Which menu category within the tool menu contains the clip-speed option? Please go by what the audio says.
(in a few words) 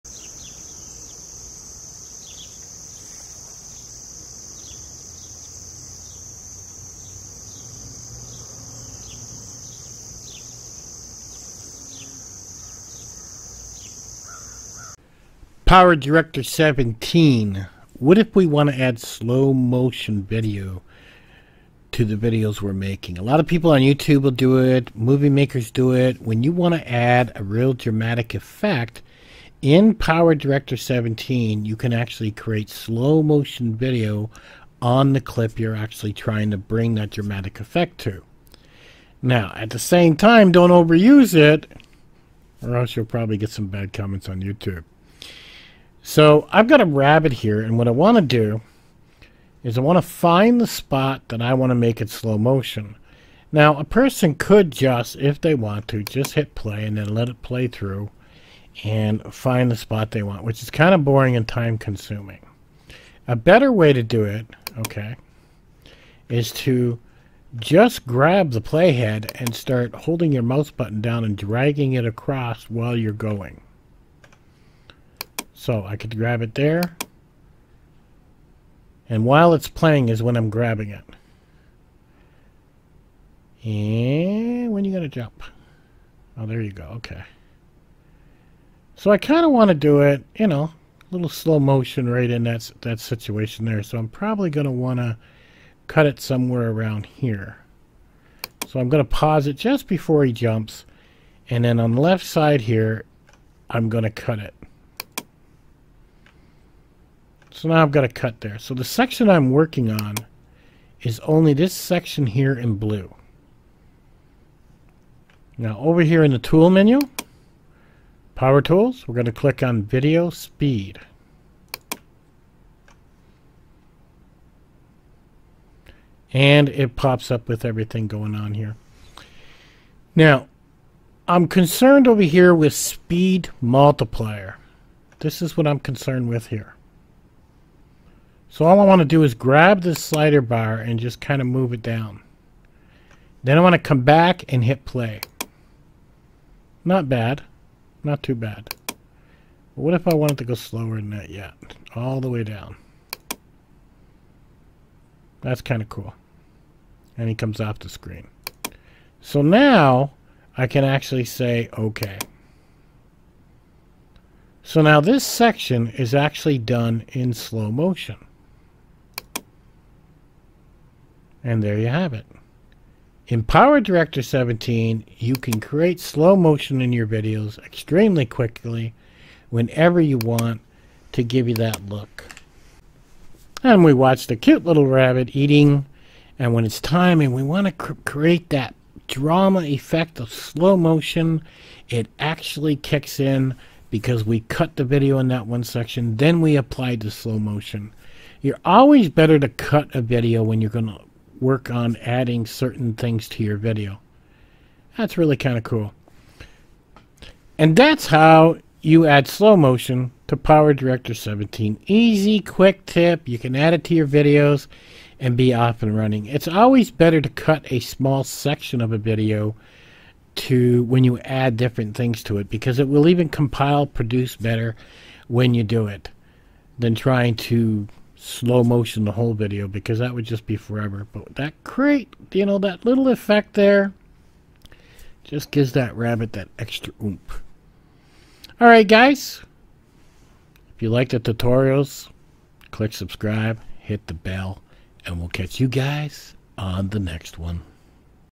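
Power tools.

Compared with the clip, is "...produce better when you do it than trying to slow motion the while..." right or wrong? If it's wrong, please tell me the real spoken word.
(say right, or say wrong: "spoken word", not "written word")
wrong: "whole", not "while".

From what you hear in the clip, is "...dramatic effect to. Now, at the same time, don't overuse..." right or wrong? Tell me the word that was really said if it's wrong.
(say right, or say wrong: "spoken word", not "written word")
right.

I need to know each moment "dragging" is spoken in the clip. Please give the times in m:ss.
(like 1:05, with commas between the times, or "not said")
1:11.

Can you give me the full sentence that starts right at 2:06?
And it pops up with everything going on here.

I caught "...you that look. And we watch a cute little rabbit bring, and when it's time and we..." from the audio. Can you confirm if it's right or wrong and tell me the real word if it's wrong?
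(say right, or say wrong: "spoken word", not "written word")
wrong: "eating", not "bring".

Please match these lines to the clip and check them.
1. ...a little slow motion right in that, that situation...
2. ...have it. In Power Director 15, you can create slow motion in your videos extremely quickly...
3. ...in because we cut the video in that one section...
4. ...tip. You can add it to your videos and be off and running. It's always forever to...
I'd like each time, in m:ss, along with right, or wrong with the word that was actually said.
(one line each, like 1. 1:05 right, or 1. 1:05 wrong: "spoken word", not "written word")
1. 1:30 right
2. 2:51 wrong: "17", not "15"
3. 3:13 right
4. 3:32 wrong: "better", not "forever".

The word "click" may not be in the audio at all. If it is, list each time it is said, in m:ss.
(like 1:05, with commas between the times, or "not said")
1:59, 4:02.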